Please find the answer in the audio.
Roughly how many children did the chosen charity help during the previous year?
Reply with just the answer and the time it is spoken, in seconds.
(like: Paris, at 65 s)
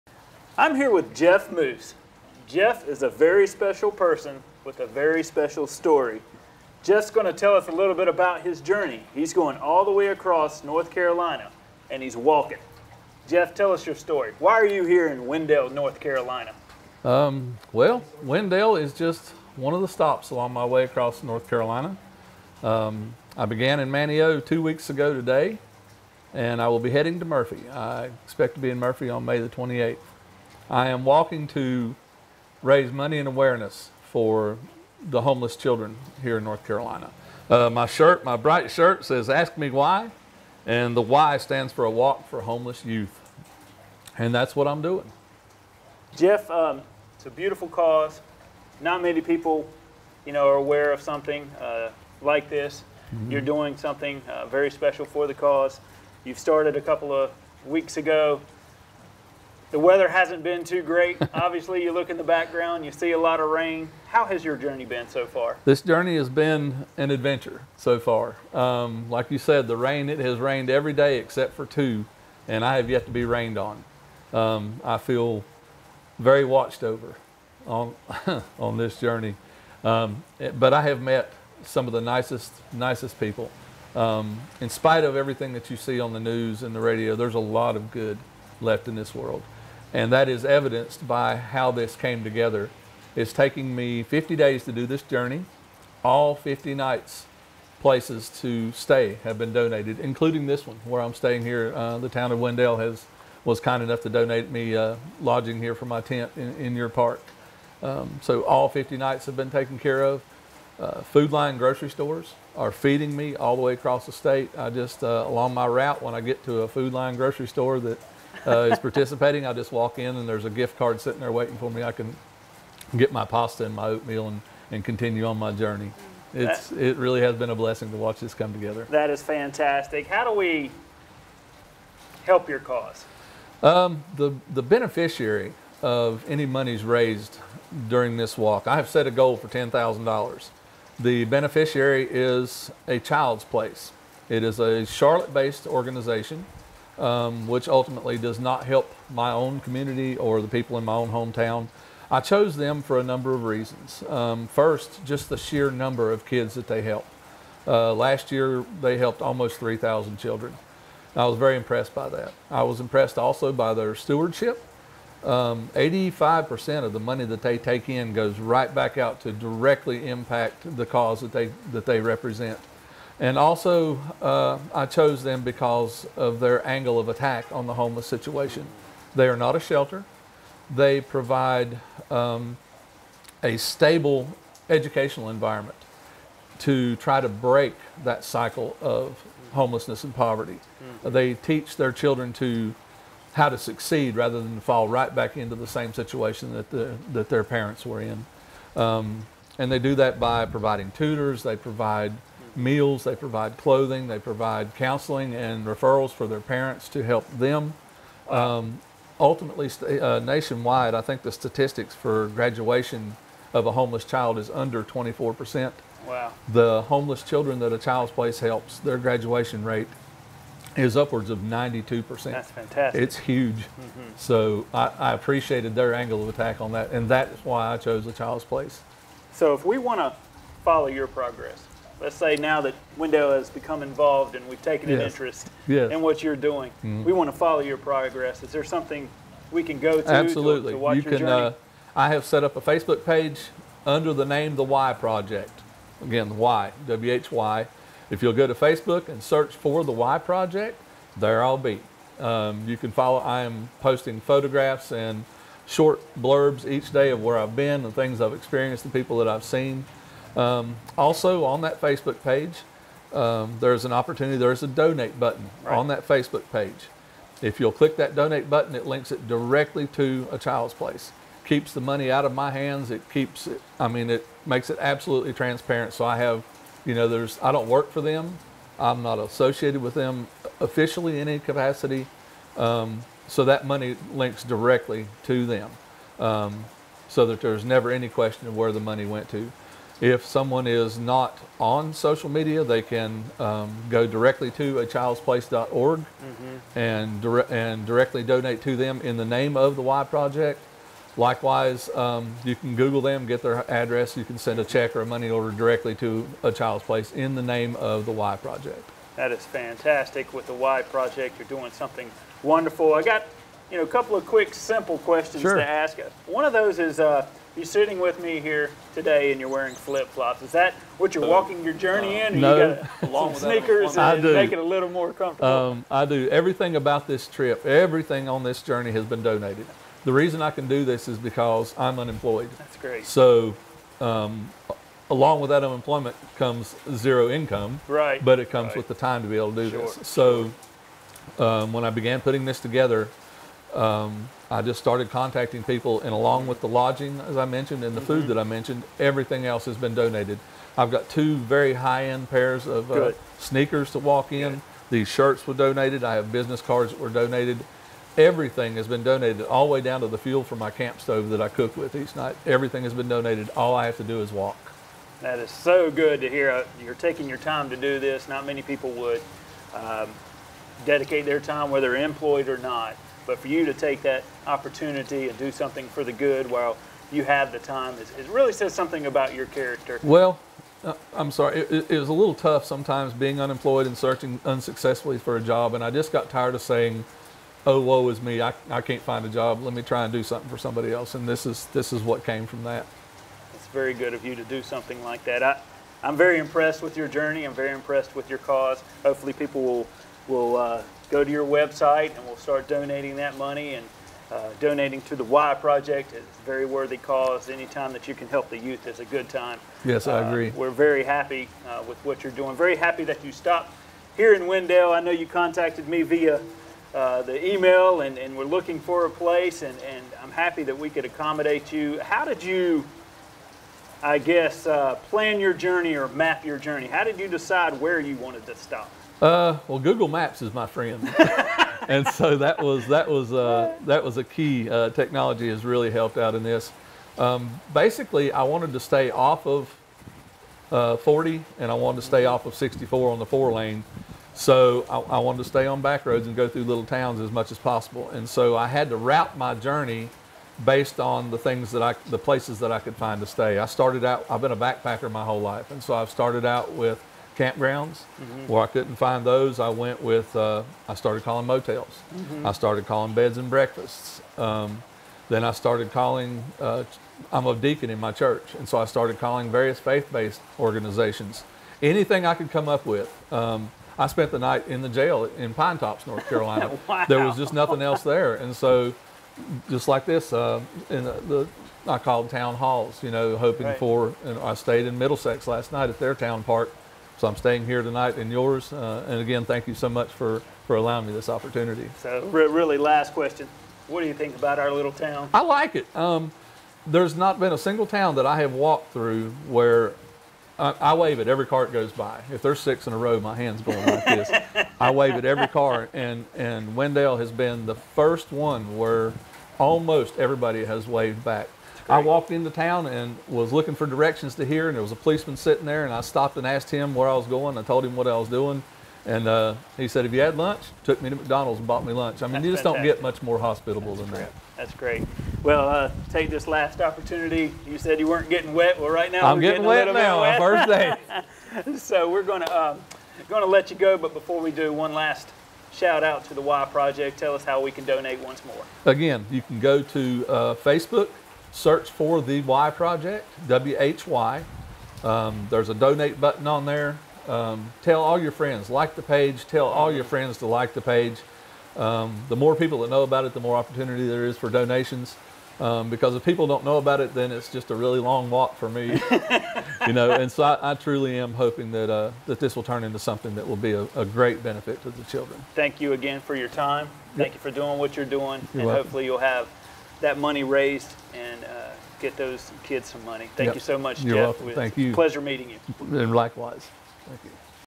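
3,000, at 159 s.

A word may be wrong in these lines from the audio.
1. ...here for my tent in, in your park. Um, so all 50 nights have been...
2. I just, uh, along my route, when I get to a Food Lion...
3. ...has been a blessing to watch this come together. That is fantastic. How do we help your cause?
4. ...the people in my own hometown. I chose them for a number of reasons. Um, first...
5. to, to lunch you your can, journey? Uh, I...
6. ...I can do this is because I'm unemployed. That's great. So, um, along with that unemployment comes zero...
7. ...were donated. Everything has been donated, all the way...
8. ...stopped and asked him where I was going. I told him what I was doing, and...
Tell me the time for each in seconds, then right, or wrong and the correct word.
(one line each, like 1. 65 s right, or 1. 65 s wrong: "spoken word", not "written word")
1. 105 s right
2. 114 s right
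3. 127 s right
4. 150 s right
5. 240 s wrong: "watch", not "lunch"
6. 330 s right
7. 356 s right
8. 516 s right.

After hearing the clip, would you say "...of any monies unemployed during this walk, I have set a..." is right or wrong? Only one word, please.
wrong.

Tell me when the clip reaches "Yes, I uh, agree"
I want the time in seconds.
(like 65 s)
409 s.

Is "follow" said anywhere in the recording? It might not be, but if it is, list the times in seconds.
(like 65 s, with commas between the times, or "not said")
230 s, 237 s, 252 s.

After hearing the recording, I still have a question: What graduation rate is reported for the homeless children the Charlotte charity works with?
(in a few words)
92%.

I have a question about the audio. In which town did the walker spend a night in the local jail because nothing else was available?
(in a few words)
Pinetops.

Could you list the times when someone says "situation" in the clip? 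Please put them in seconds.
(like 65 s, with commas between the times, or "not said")
178 s, 195 s.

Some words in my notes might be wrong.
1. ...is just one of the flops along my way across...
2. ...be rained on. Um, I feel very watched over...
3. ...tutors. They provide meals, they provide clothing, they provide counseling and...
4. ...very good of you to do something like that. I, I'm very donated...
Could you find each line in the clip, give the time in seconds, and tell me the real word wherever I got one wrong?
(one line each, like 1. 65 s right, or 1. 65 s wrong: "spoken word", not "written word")
1. 18 s wrong: "stops", not "flops"
2. 73 s right
3. 200 s right
4. 393 s wrong: "impressed", not "donated".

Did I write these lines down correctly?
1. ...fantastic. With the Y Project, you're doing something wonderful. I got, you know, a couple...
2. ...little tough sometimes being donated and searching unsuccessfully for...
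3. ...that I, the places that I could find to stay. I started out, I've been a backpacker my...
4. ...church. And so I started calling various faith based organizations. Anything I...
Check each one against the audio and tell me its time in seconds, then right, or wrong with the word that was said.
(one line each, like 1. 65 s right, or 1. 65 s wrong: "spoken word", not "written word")
1. 309 s right
2. 382 s wrong: "unemployed", not "donated"
3. 451 s right
4. 468 s right.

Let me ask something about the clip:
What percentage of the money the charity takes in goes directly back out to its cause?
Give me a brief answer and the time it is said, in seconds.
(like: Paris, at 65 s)
85%, at 165 s.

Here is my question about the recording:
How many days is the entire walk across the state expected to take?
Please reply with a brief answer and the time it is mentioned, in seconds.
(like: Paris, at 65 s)
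50, at 94 s.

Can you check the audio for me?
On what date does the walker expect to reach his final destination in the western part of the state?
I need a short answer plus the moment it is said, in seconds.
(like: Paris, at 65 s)
May 28, at 29 s.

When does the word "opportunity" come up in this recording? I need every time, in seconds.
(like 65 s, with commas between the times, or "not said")
263 s, 374 s, 491 s, 526 s, 553 s.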